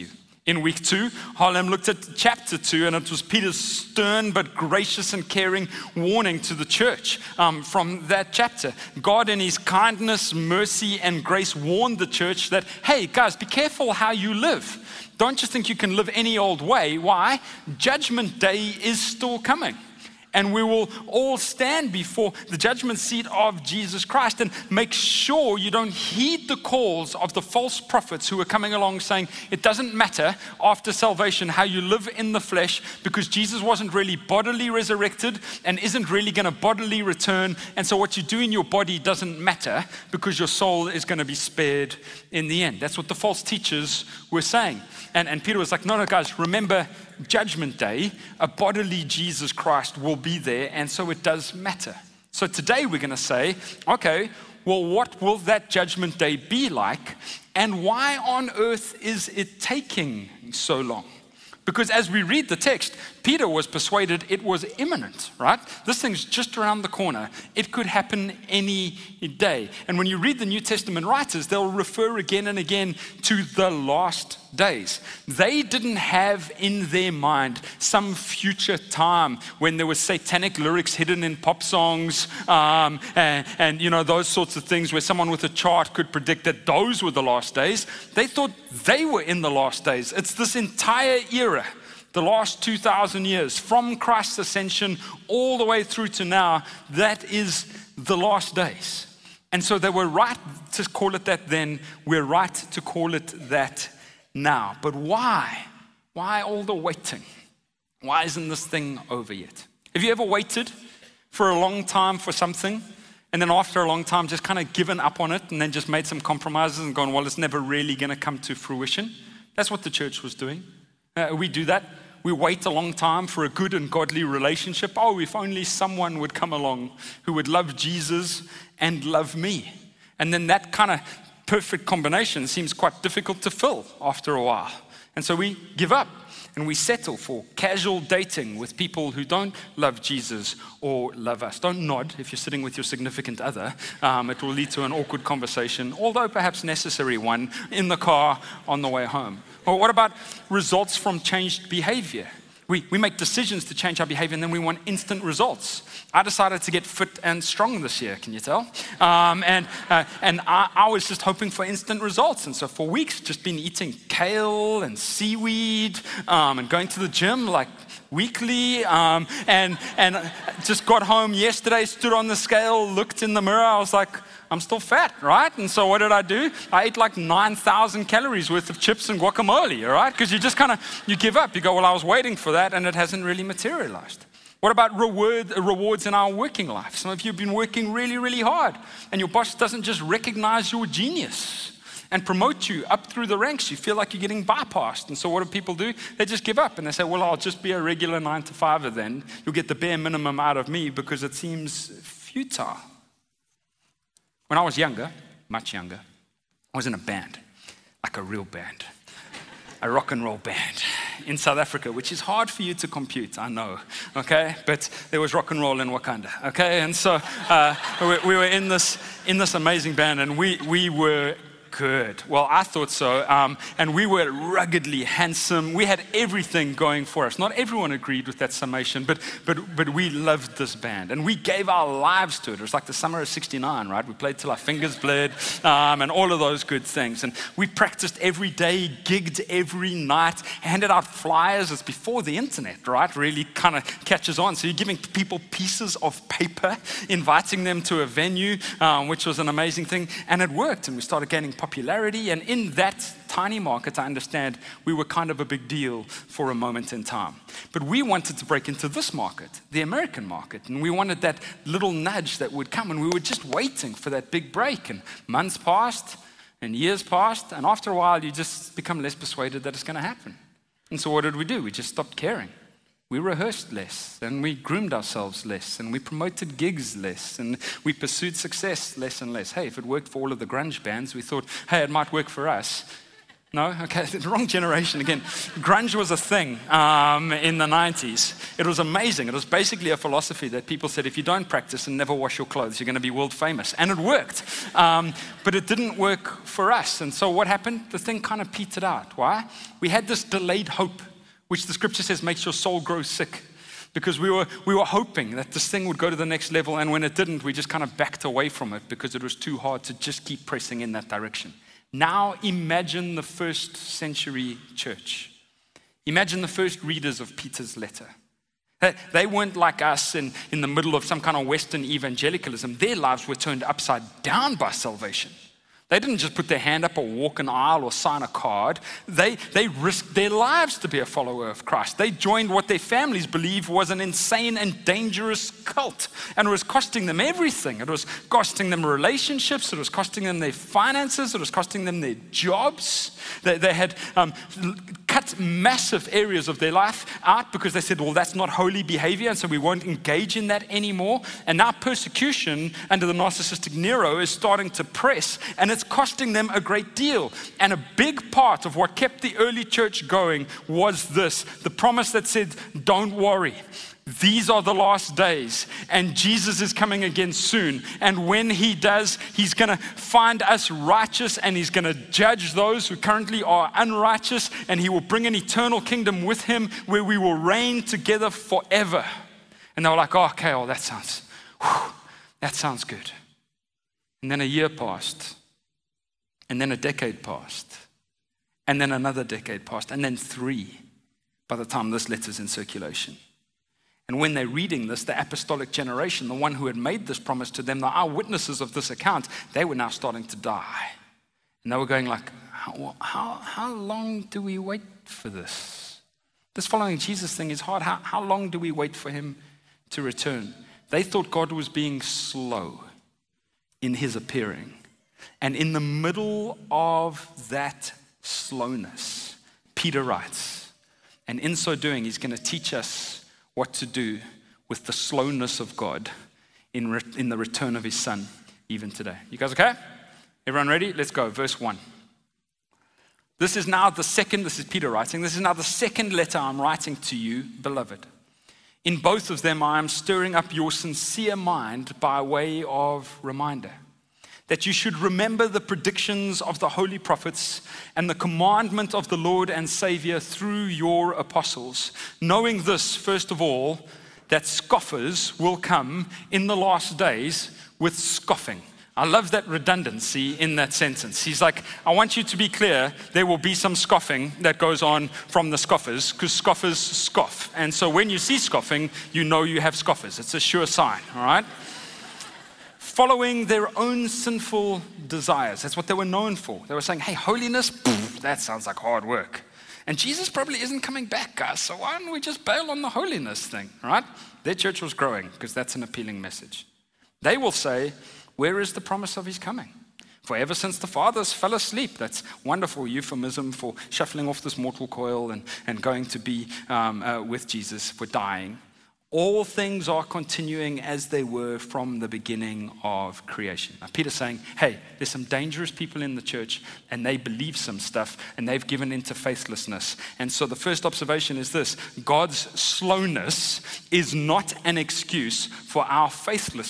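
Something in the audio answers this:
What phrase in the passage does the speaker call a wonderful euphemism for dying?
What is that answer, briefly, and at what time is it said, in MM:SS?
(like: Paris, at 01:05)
Fell asleep, at 08:11.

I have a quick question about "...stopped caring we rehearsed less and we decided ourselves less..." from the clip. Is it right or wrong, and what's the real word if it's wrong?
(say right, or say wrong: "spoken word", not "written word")
wrong: "groomed", not "decided".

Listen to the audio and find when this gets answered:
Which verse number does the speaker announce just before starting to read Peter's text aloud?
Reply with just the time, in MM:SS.
07:11.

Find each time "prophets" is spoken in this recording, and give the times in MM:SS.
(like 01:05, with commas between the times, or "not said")
00:27, 07:26.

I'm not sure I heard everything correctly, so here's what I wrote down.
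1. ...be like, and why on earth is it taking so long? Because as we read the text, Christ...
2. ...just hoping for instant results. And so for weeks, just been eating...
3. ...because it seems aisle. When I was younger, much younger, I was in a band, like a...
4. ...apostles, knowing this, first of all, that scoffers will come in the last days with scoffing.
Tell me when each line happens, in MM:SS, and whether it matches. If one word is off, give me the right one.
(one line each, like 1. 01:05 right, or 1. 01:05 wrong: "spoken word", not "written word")
1. 00:56 wrong: "Peter", not "Christ"
2. 02:41 right
3. 03:20 wrong: "futile", not "aisle"
4. 07:31 right.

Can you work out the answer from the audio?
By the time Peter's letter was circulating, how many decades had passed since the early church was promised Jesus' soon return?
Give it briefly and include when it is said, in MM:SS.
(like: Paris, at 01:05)
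3, at 06:30.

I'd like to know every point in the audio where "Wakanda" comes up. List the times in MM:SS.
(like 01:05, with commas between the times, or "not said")
03:35.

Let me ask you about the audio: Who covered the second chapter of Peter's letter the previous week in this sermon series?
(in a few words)
Halim.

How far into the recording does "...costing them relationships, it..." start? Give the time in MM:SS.
05:38.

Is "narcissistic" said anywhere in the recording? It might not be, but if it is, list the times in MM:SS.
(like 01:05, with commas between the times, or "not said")
05:53.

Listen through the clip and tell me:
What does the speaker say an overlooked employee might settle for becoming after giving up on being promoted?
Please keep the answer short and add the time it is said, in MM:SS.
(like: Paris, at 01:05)
A regular nine to fiver, at 03:17.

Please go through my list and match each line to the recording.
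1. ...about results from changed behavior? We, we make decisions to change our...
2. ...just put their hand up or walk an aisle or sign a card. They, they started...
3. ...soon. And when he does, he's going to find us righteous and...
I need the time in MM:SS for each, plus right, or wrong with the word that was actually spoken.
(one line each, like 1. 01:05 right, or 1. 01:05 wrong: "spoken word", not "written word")
1. 02:29 right
2. 05:26 wrong: "risked", not "started"
3. 06:07 right.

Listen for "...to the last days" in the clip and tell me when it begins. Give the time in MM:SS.
01:13.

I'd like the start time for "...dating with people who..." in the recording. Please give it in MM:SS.
02:17.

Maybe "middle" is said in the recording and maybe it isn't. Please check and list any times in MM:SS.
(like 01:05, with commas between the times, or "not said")
05:20, 06:55.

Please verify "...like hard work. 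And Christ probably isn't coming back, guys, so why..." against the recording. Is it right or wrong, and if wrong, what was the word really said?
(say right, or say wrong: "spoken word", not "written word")
wrong: "Jesus", not "Christ".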